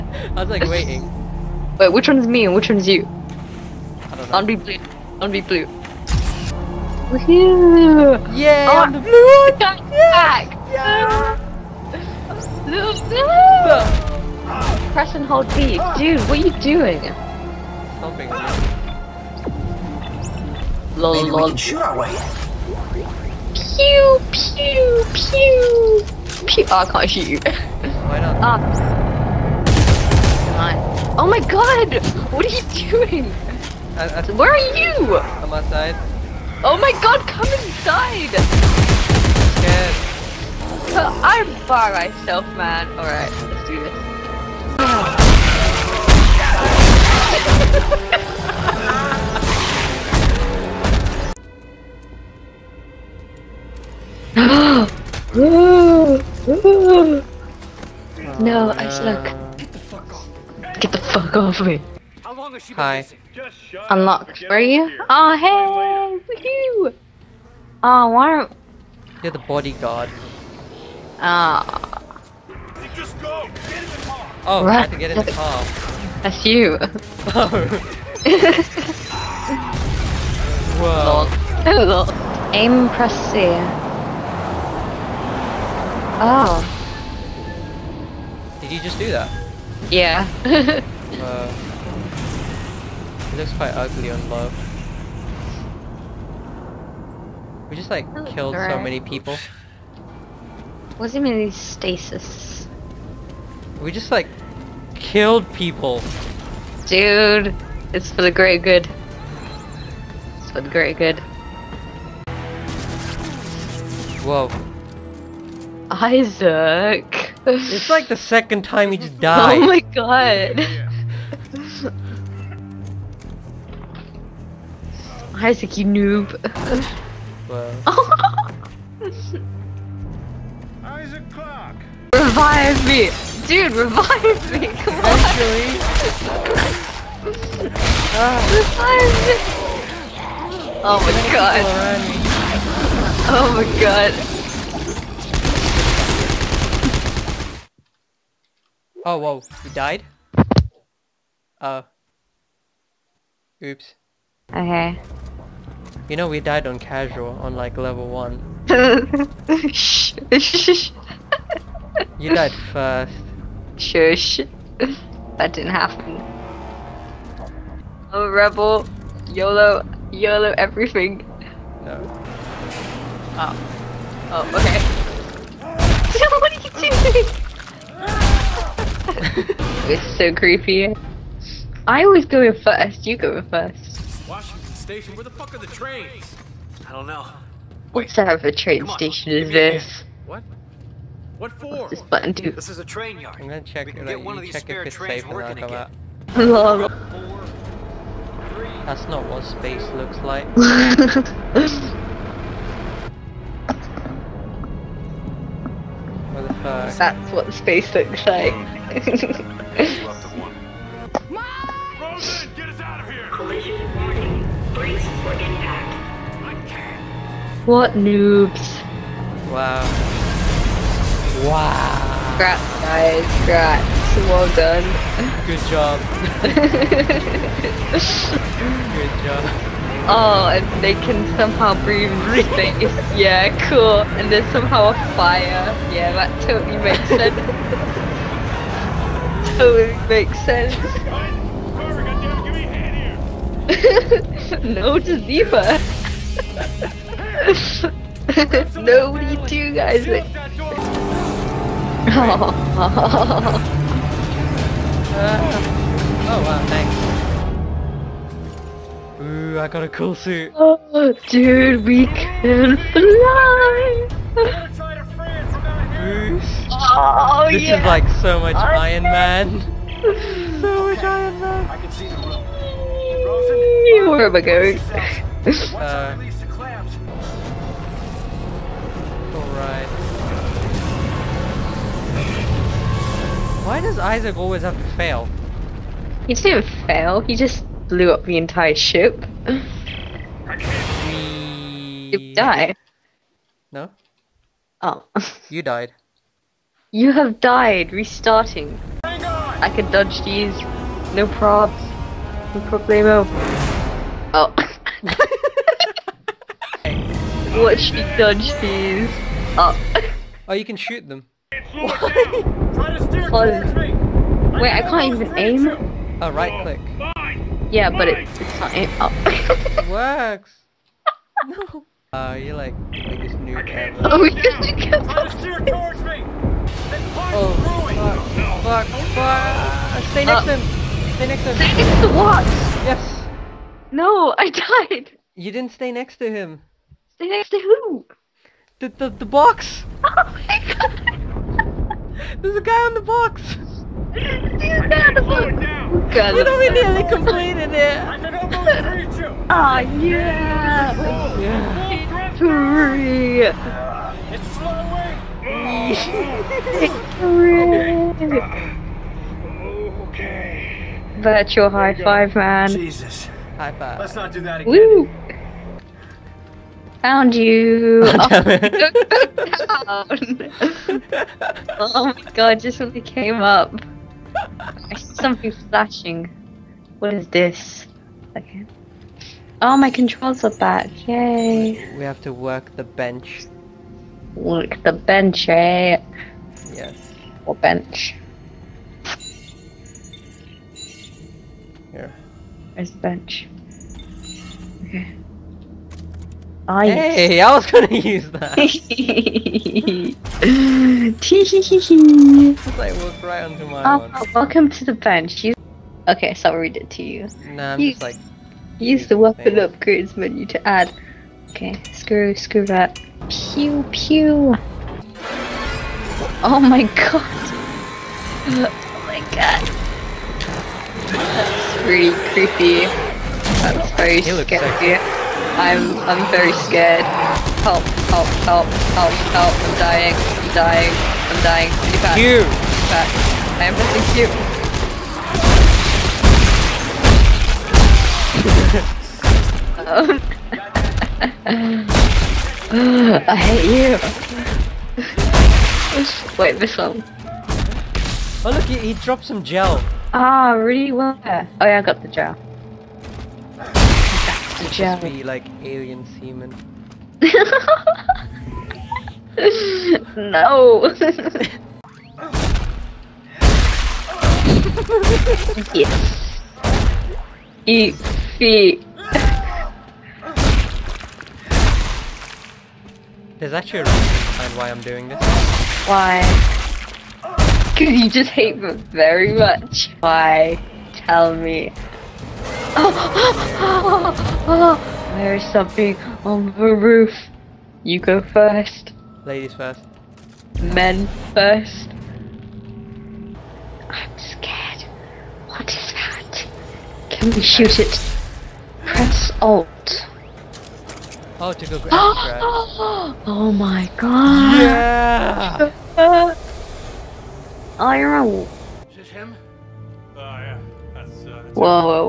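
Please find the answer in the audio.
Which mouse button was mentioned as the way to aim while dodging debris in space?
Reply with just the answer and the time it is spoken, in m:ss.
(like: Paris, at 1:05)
Right click, at 5:16.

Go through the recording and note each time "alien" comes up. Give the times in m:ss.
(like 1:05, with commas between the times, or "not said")
7:35.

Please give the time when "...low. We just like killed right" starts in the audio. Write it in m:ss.
1:34.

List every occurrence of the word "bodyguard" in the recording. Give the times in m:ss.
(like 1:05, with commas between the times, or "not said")
1:09.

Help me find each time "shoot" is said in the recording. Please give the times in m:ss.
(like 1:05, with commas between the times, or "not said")
0:21, 0:27, 5:10, 8:17.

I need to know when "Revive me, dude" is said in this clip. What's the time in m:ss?
2:12.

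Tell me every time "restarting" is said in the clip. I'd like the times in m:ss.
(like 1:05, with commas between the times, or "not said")
4:57.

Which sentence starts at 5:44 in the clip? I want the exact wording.
God, we don't really nearly completed it.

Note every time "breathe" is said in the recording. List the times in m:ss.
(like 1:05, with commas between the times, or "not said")
3:51.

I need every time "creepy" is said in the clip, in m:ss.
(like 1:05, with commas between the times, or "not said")
3:00, 7:02.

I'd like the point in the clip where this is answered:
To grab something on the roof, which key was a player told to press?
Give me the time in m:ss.
8:18.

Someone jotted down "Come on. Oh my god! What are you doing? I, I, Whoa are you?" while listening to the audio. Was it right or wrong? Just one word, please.
wrong.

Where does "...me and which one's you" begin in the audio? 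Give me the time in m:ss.
0:02.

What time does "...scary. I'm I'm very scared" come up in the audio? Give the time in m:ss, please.
7:04.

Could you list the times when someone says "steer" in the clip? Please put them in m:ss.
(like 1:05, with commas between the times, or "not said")
5:25.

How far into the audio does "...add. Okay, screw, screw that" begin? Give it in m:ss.
6:50.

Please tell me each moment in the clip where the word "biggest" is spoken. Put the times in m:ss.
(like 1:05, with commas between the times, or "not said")
5:23.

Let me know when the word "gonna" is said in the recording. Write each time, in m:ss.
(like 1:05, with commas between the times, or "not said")
3:13, 6:37.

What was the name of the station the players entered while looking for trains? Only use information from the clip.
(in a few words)
Washington Station.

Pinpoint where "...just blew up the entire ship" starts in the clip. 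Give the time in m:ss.
4:47.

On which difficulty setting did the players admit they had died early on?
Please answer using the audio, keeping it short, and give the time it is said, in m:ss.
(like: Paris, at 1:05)
Casual, at 2:36.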